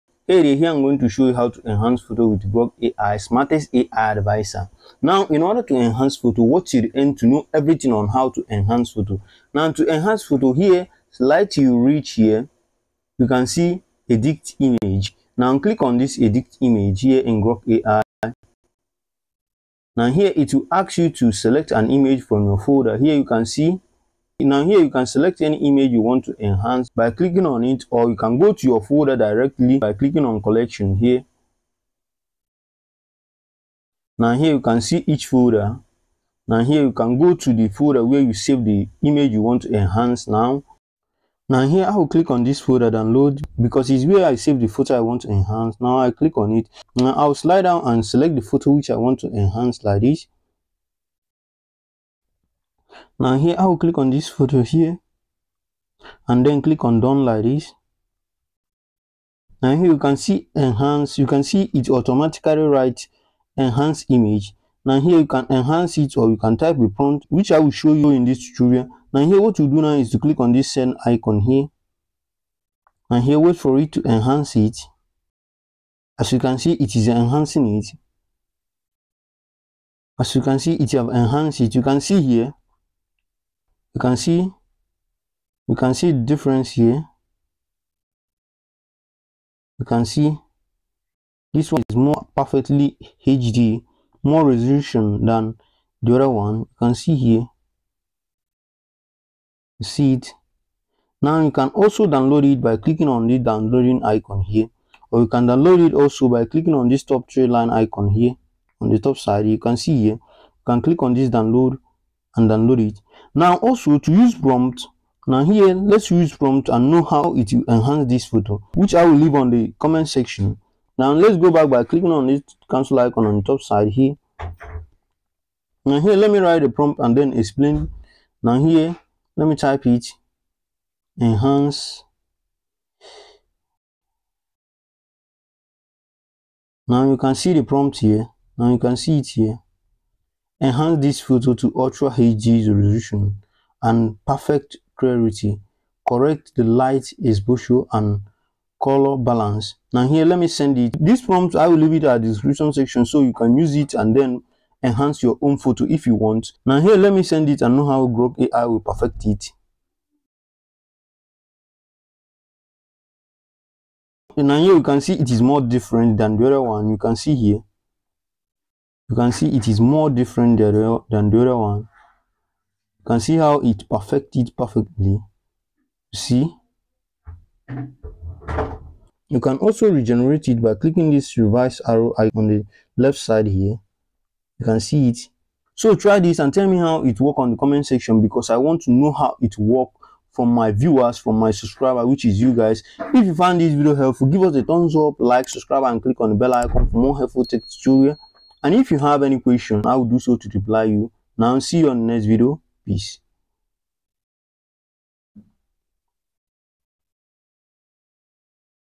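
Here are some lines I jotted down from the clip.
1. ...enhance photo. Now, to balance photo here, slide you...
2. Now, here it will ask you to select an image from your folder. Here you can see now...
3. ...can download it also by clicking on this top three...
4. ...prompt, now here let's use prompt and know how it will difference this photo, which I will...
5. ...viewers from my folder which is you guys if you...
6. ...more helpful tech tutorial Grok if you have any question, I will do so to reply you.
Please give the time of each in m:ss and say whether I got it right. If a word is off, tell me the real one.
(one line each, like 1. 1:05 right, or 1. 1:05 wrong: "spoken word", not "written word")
1. 0:08 wrong: "enhance", not "balance"
2. 0:19 right
3. 1:45 right
4. 1:54 wrong: "enhance", not "difference"
5. 3:10 wrong: "subscriber", not "folder"
6. 3:16 wrong: "And", not "Grok".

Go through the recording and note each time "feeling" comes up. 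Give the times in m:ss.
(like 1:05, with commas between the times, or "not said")
not said.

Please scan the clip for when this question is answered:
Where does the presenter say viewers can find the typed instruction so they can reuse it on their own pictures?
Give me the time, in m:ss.
2:32.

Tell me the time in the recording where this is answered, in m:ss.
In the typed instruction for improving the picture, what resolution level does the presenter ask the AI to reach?
2:21.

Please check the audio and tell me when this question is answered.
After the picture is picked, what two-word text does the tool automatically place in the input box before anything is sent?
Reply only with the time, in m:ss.
1:03.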